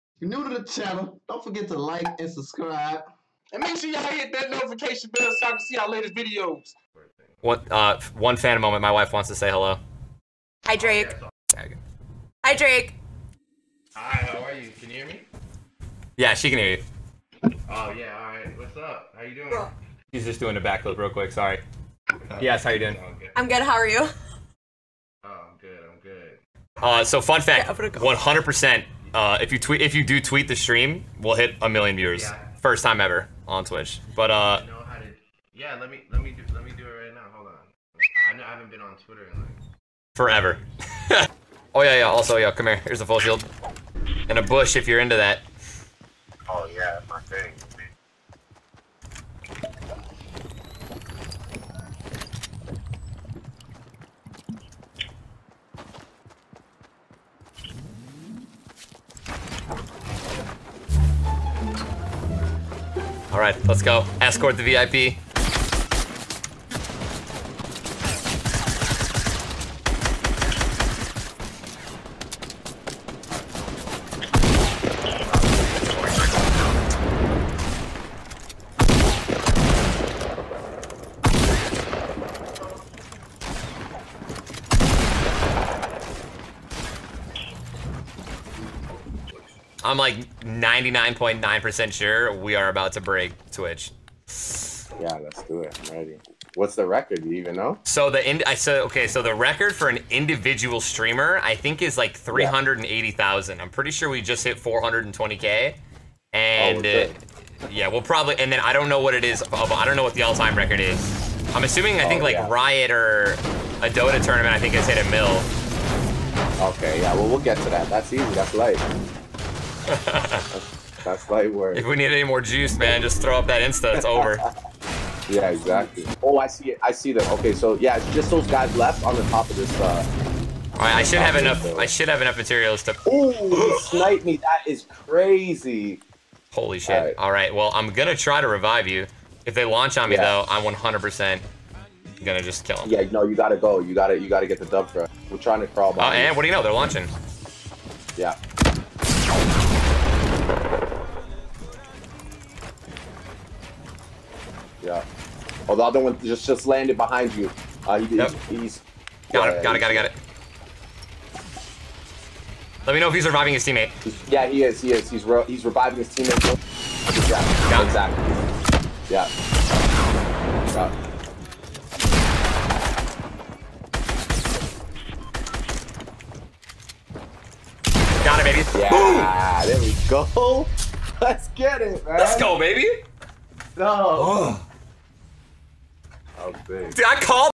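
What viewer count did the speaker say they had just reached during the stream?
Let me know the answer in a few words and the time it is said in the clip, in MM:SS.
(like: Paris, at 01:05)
420k, at 01:44.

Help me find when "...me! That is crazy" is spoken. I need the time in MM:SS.
02:14.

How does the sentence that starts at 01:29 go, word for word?
I'm like 99.9% sure we are about to break Twitch.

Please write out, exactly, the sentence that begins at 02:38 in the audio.
he's, he's got, yeah, him, got, it.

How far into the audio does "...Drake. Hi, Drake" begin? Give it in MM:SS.
00:10.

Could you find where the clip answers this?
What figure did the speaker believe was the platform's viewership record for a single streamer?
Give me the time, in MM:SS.
01:42.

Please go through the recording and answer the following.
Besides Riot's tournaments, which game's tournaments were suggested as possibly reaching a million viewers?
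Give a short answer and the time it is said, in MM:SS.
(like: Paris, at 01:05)
Dota, at 01:53.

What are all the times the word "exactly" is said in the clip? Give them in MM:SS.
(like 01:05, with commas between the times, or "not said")
02:05, 02:47.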